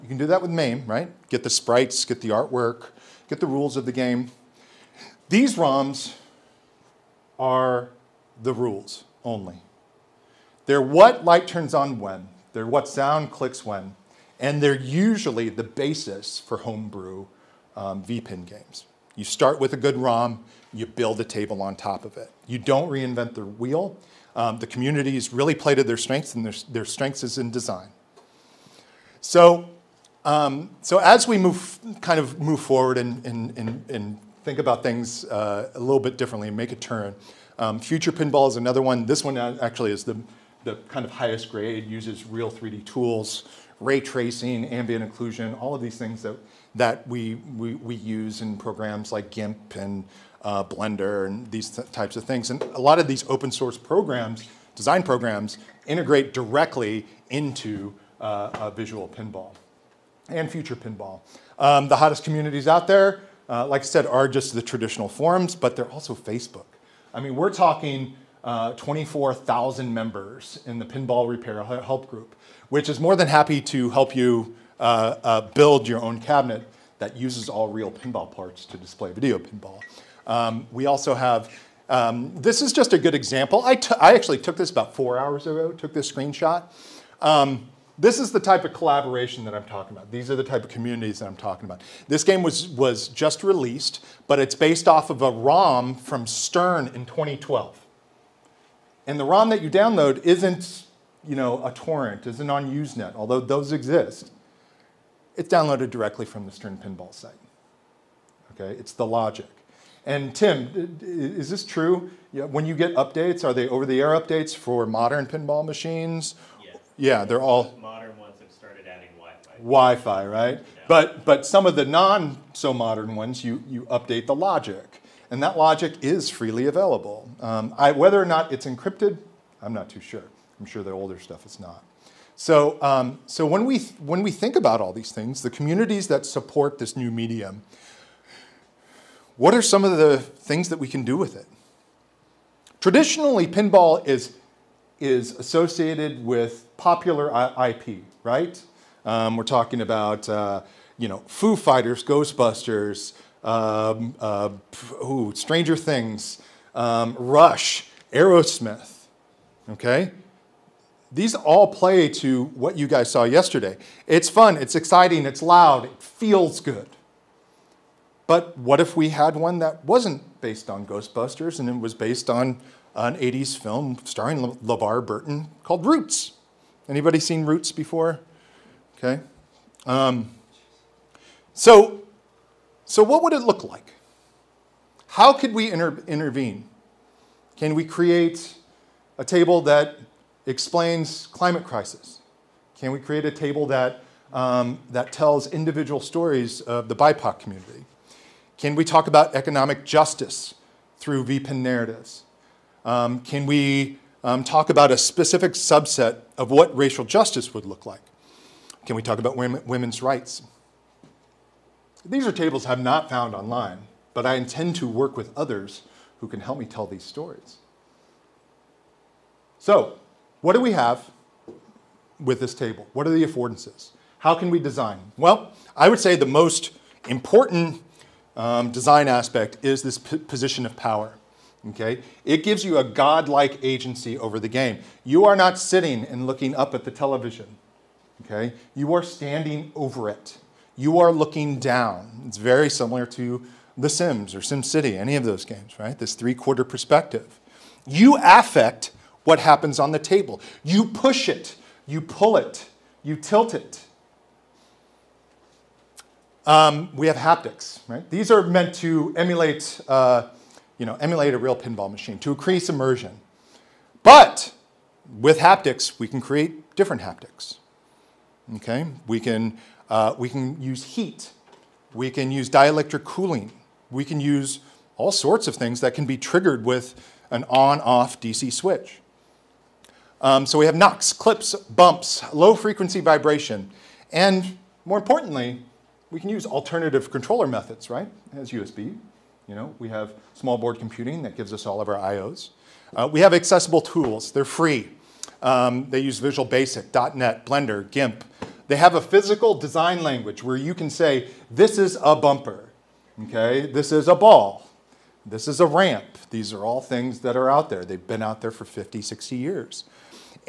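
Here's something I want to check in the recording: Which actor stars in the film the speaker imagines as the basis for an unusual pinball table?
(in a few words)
LeVar Burton.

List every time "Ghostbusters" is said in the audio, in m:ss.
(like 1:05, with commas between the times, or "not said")
2:32, 2:50.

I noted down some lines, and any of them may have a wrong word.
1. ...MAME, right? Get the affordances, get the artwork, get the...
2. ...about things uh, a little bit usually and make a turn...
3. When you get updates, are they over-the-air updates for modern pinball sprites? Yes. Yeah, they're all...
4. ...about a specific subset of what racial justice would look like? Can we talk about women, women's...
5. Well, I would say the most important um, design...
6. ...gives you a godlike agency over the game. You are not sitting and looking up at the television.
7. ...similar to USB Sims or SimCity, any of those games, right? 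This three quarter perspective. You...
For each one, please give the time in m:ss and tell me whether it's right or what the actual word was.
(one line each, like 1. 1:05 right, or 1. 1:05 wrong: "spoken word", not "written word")
1. 0:00 wrong: "sprites", not "affordances"
2. 0:34 wrong: "differently", not "usually"
3. 1:52 wrong: "machines", not "sprites"
4. 3:24 right
5. 3:45 right
6. 3:52 right
7. 4:02 wrong: "The", not "USB".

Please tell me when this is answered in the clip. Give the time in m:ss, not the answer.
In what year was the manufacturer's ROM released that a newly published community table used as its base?
1:37.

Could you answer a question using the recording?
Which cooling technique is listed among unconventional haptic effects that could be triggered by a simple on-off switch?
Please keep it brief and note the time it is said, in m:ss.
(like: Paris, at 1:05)
Dielectric cooling, at 4:32.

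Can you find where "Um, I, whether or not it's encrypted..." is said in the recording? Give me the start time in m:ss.
2:07.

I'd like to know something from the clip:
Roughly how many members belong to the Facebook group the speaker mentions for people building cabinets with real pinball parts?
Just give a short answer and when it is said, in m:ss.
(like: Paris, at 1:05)
24,000, at 1:08.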